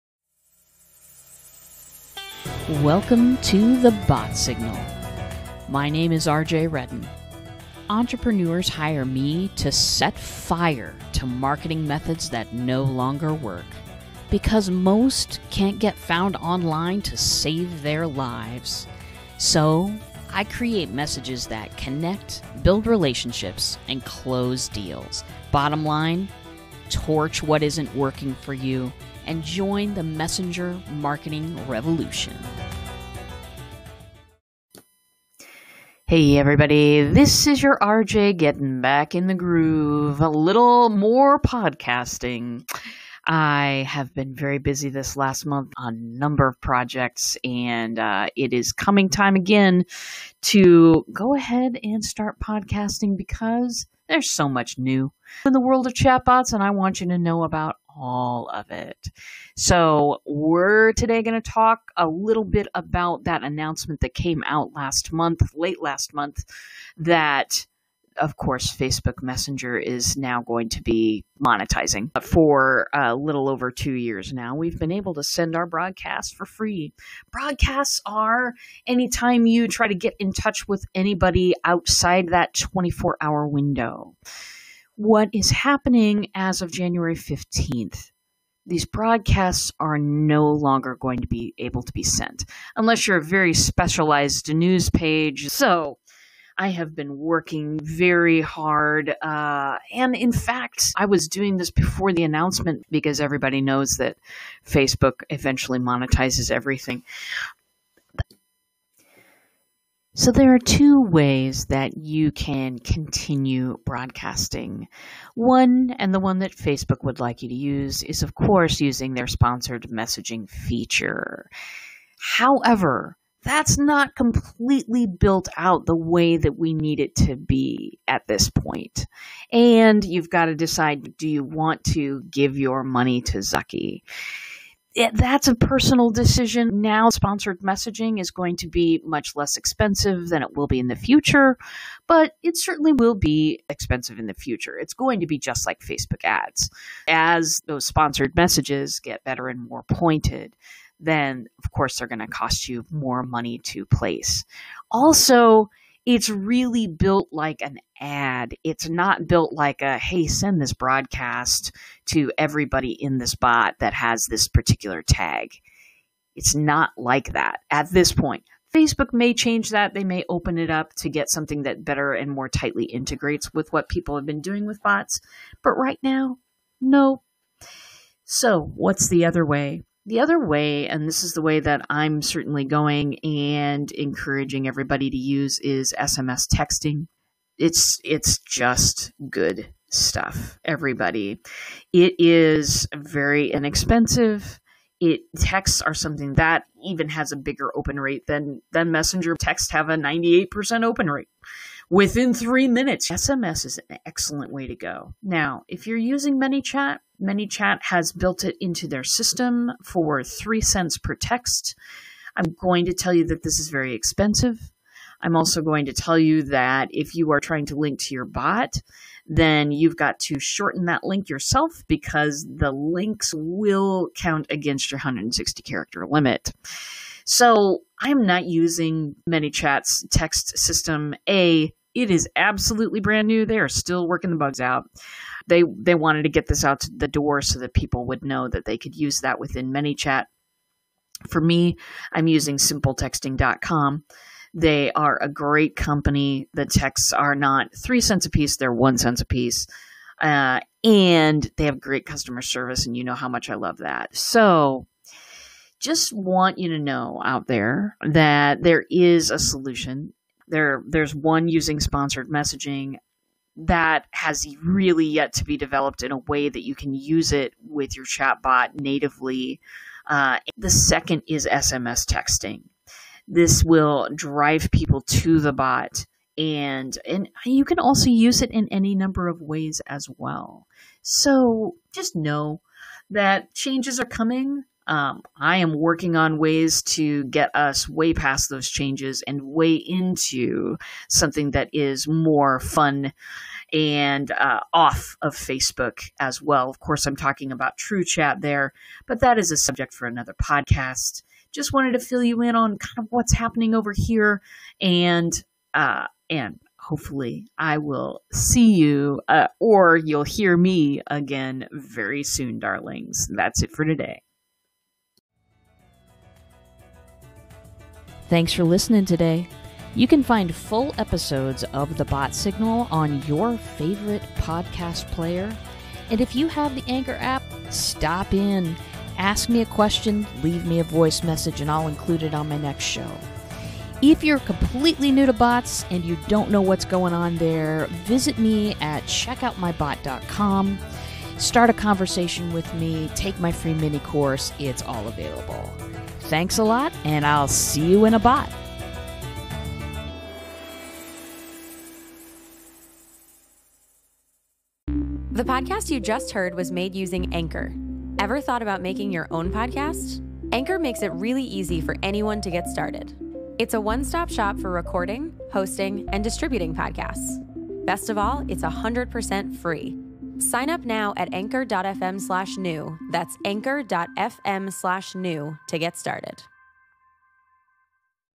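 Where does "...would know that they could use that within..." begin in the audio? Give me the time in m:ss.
3:58.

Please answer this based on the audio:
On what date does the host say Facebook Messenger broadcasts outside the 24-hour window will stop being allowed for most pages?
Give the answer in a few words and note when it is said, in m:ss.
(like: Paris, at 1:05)
January 15th, at 1:26.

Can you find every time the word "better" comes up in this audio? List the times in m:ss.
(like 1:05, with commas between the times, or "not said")
2:29, 2:51.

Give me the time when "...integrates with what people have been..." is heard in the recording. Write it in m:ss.
2:52.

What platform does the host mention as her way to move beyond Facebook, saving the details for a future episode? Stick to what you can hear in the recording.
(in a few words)
True Chat.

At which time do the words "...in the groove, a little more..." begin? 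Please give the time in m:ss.
0:39.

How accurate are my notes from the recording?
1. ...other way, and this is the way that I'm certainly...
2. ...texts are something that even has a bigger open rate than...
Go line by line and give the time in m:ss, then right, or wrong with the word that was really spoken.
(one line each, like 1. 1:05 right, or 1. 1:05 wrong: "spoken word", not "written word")
1. 3:00 right
2. 3:15 right.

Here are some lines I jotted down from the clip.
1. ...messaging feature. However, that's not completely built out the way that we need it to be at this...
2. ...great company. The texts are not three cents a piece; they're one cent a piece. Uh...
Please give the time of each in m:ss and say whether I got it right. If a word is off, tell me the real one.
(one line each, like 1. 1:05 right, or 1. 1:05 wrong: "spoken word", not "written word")
1. 1:59 right
2. 4:05 right.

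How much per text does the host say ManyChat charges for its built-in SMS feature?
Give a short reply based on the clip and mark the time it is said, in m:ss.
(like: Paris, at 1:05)
3 cents, at 3:30.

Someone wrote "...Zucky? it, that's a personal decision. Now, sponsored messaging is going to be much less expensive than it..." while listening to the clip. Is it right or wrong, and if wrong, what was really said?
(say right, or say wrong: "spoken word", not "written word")
right.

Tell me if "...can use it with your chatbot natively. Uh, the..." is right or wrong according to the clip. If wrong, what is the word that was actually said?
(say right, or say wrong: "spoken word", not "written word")
right.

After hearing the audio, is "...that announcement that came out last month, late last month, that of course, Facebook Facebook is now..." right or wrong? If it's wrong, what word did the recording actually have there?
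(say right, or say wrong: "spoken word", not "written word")
wrong: "Messenger", not "Facebook".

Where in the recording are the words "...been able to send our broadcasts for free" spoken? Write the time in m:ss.
1:14.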